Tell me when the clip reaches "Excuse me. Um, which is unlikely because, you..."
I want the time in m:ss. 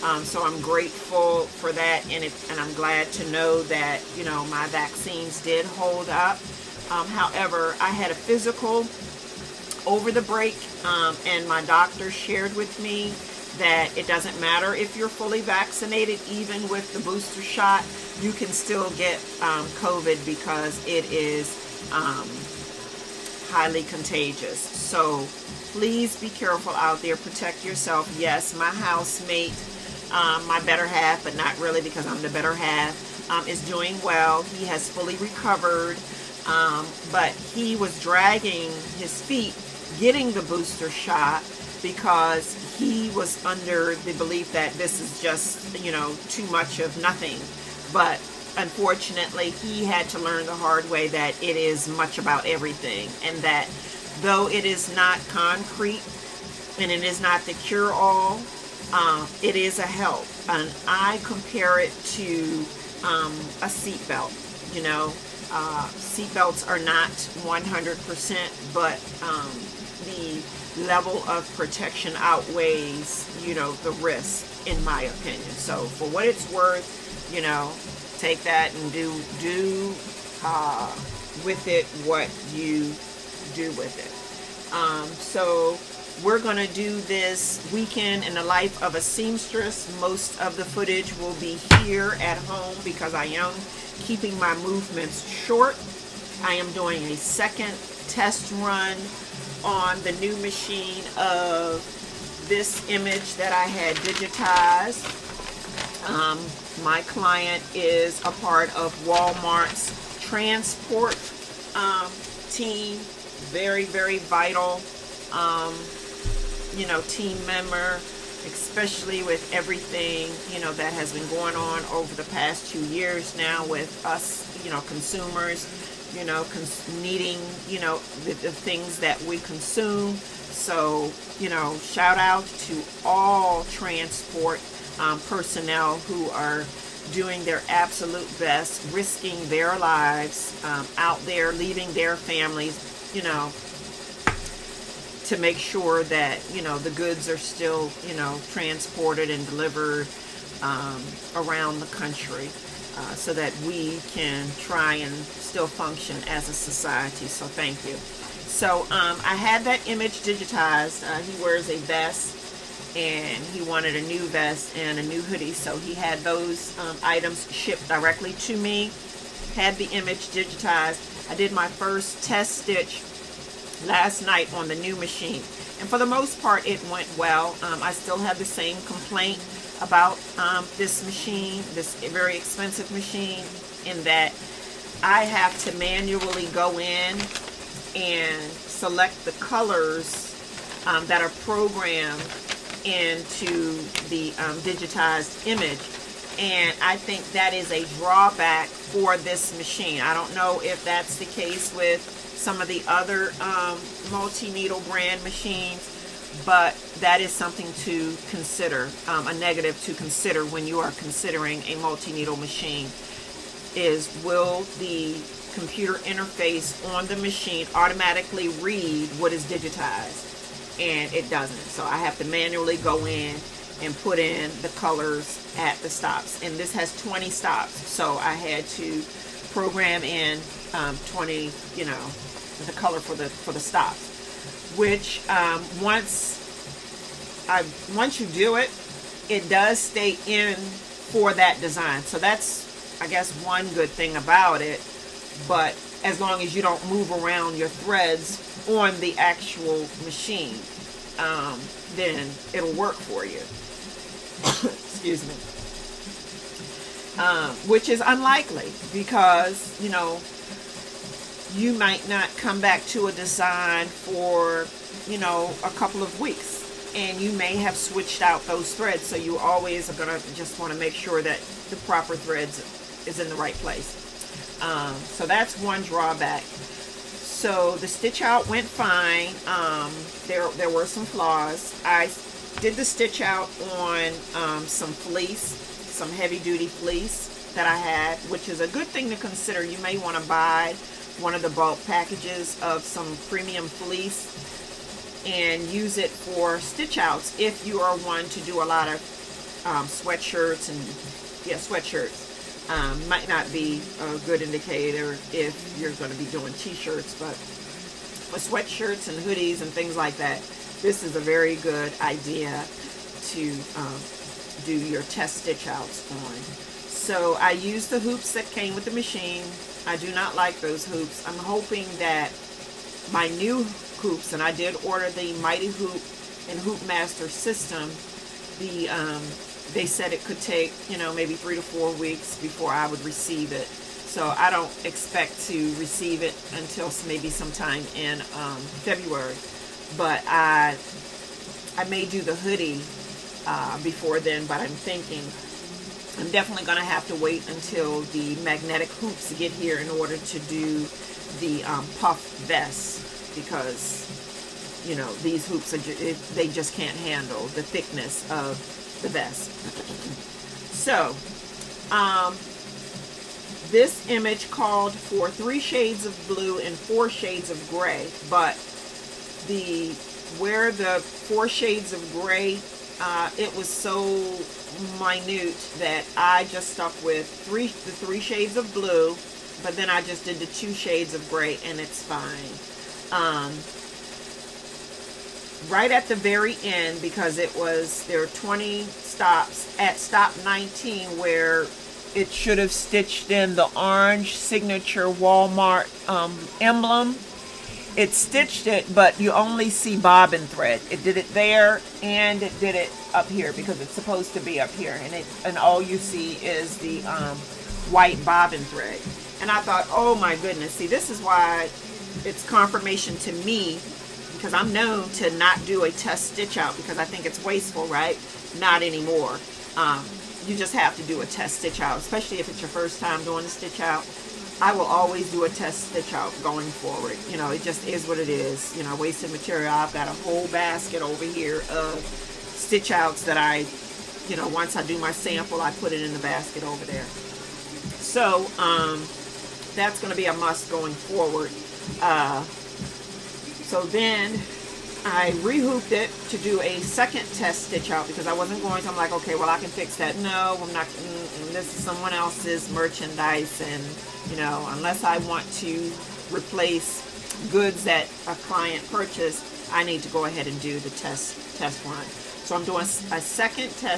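4:14.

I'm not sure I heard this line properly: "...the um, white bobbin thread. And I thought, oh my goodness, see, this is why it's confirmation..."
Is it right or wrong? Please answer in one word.
right.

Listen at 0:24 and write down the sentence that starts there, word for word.
So please be careful out there.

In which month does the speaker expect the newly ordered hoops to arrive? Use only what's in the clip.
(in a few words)
February.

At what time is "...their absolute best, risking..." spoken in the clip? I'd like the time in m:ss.
2:17.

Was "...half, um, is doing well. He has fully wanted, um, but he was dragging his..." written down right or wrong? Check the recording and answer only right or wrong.
wrong.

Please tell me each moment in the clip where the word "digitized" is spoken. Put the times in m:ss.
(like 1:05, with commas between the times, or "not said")
1:43, 2:40, 2:50, 3:14, 3:39.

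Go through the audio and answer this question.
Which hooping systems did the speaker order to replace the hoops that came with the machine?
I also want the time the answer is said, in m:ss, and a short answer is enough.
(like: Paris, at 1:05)
Mighty Hoop and Hoop Master, at 5:25.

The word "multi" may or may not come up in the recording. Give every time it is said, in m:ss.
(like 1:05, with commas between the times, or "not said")
3:24, 3:31.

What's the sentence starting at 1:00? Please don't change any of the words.
And I compare it to um, a seatbelt.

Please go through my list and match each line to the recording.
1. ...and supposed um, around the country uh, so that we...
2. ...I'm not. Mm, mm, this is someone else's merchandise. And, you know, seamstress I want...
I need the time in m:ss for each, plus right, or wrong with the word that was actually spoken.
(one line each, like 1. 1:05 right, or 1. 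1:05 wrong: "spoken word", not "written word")
1. 2:29 wrong: "delivered", not "supposed"
2. 7:30 wrong: "unless", not "seamstress".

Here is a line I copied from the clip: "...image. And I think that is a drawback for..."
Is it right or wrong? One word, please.
right.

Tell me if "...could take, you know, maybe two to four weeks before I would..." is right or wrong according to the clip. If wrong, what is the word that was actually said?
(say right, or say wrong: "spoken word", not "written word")
wrong: "three", not "two".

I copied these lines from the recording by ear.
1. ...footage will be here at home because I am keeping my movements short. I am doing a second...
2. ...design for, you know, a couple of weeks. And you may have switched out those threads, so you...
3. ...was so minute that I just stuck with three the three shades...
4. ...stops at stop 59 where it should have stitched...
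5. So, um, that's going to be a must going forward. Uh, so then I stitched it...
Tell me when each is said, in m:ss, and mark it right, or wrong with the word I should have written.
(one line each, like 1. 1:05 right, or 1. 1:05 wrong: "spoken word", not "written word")
1. 1:30 right
2. 4:23 right
3. 6:13 right
4. 6:28 wrong: "19", not "59"
5. 7:17 wrong: "rehooped", not "stitched".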